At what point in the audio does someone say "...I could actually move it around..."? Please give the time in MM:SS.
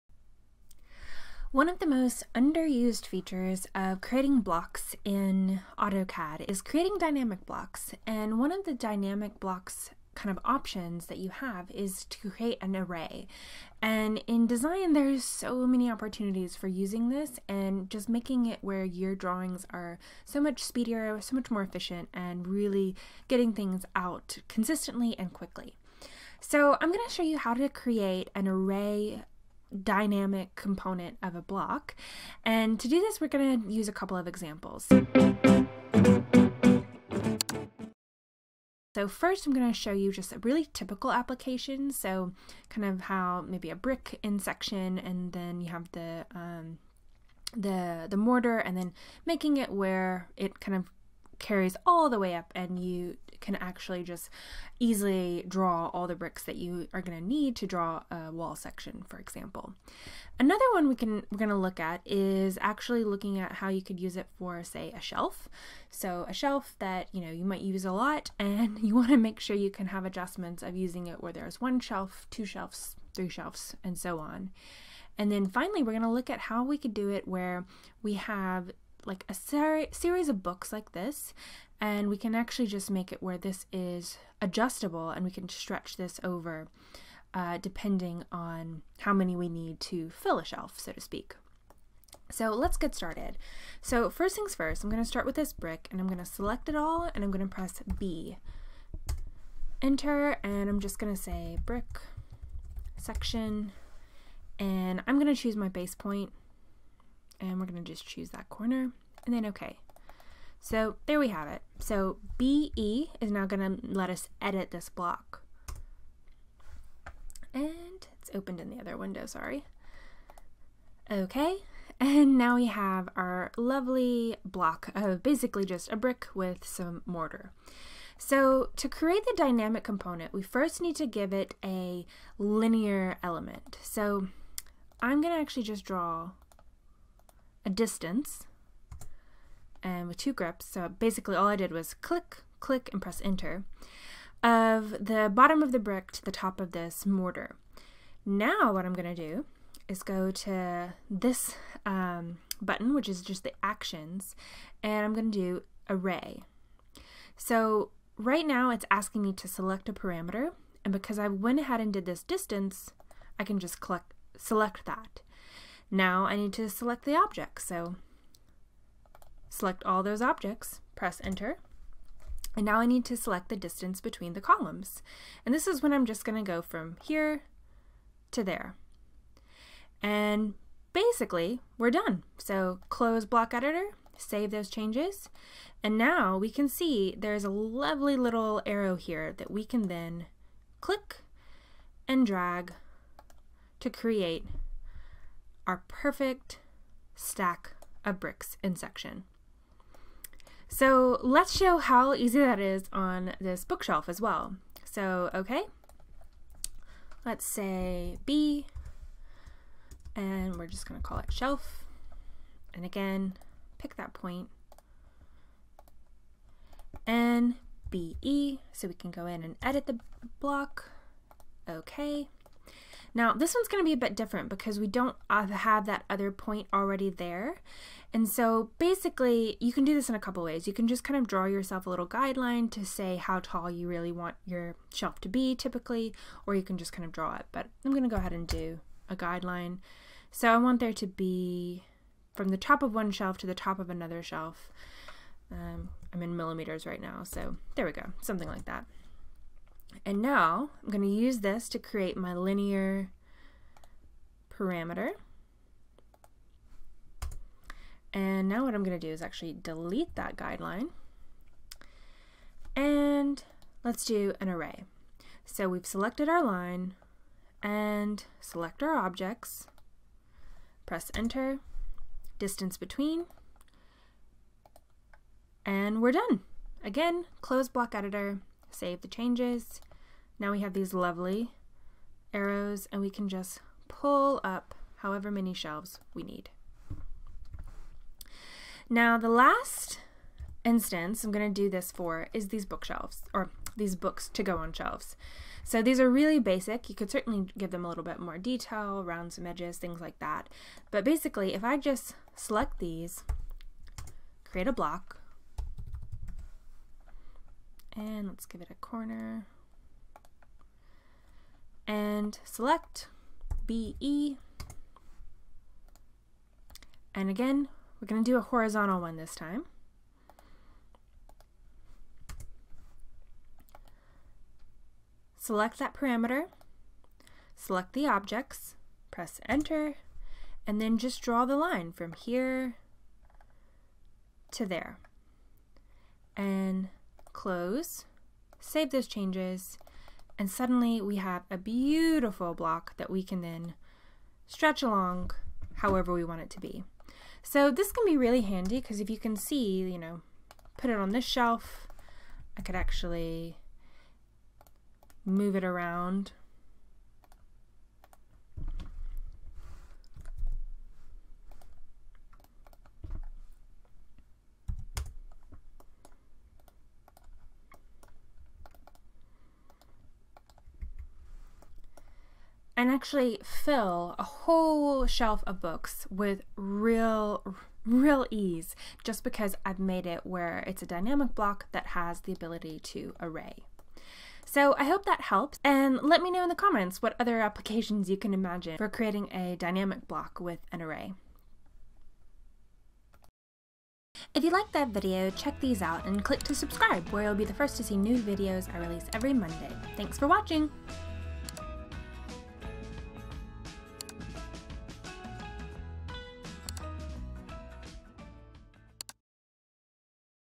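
05:52.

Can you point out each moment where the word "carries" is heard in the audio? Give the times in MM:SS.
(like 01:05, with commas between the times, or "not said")
00:51.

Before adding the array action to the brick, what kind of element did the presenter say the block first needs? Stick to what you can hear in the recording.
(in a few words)
a linear element.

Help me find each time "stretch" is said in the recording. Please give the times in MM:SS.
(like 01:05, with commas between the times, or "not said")
01:25, 05:44.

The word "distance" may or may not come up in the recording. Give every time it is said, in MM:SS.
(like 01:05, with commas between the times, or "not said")
02:17, 02:42, 02:53, 04:32.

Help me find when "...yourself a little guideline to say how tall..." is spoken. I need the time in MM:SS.
03:51.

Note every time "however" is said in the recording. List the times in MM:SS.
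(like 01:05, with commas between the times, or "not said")
04:44, 05:45.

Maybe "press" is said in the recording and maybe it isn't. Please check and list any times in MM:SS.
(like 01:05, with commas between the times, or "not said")
01:37, 02:23, 02:50, 04:30, 05:29.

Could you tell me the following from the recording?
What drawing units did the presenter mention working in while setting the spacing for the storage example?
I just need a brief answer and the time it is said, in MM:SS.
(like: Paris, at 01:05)
millimeters, at 04:06.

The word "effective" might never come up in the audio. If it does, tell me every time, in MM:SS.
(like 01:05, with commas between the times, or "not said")
not said.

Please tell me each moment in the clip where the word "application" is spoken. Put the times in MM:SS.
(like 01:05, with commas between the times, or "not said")
00:41, 06:27.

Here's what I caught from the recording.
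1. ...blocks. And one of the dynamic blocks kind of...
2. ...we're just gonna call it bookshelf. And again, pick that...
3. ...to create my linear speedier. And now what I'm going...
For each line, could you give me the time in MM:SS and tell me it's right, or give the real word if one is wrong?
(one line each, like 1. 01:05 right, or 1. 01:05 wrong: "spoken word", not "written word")
1. 00:07 right
2. 03:30 wrong: "shelf", not "bookshelf"
3. 04:11 wrong: "parameter", not "speedier".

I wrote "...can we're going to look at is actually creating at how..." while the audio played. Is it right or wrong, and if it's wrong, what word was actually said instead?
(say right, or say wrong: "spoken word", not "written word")
wrong: "looking", not "creating".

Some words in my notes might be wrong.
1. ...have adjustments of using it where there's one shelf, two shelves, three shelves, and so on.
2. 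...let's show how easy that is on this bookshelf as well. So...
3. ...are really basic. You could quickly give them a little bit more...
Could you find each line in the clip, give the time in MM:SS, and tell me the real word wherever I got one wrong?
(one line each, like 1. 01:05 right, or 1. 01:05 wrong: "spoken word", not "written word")
1. 01:09 right
2. 03:21 right
3. 04:55 wrong: "certainly", not "quickly".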